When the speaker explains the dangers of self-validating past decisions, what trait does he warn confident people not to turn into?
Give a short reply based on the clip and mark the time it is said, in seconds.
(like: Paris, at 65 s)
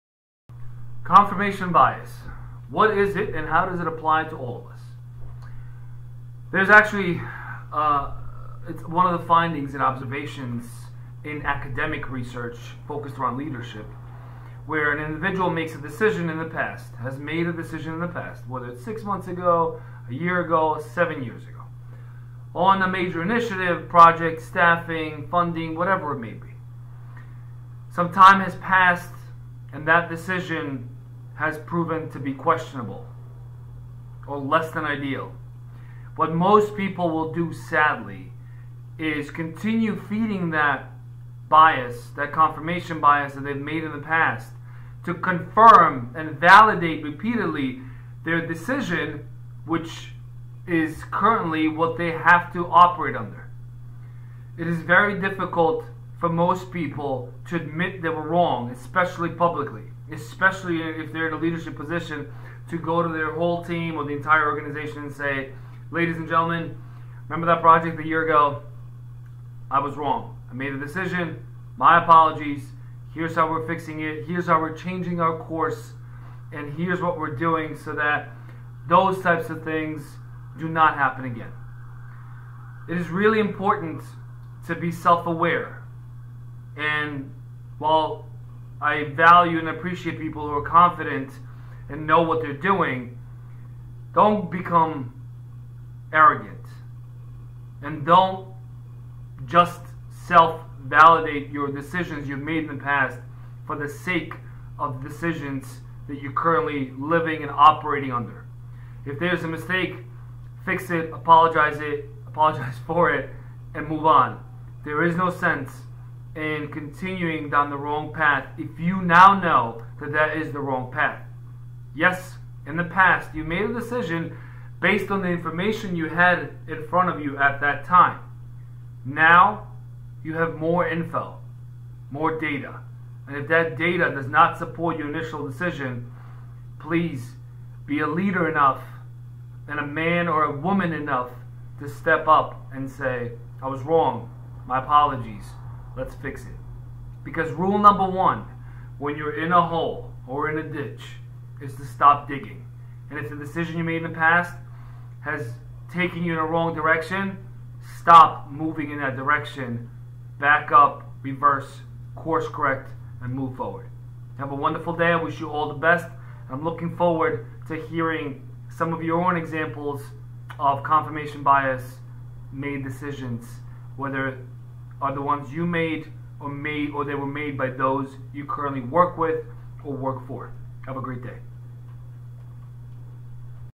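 Arrogant, at 96 s.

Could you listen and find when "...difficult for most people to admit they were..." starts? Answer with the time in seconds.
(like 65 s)
55 s.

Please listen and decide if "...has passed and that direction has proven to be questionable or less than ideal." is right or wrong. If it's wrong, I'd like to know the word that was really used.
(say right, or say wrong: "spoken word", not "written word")
wrong: "decision", not "direction".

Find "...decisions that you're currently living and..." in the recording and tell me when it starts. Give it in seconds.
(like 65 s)
105 s.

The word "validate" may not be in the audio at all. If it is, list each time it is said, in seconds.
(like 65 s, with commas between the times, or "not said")
46 s, 100 s.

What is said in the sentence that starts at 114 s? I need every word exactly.
There is no sense and continuing down the wrong path if you now know that that is the wrong path.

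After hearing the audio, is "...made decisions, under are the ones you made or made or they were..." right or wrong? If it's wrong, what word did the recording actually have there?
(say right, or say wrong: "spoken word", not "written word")
wrong: "whether", not "under".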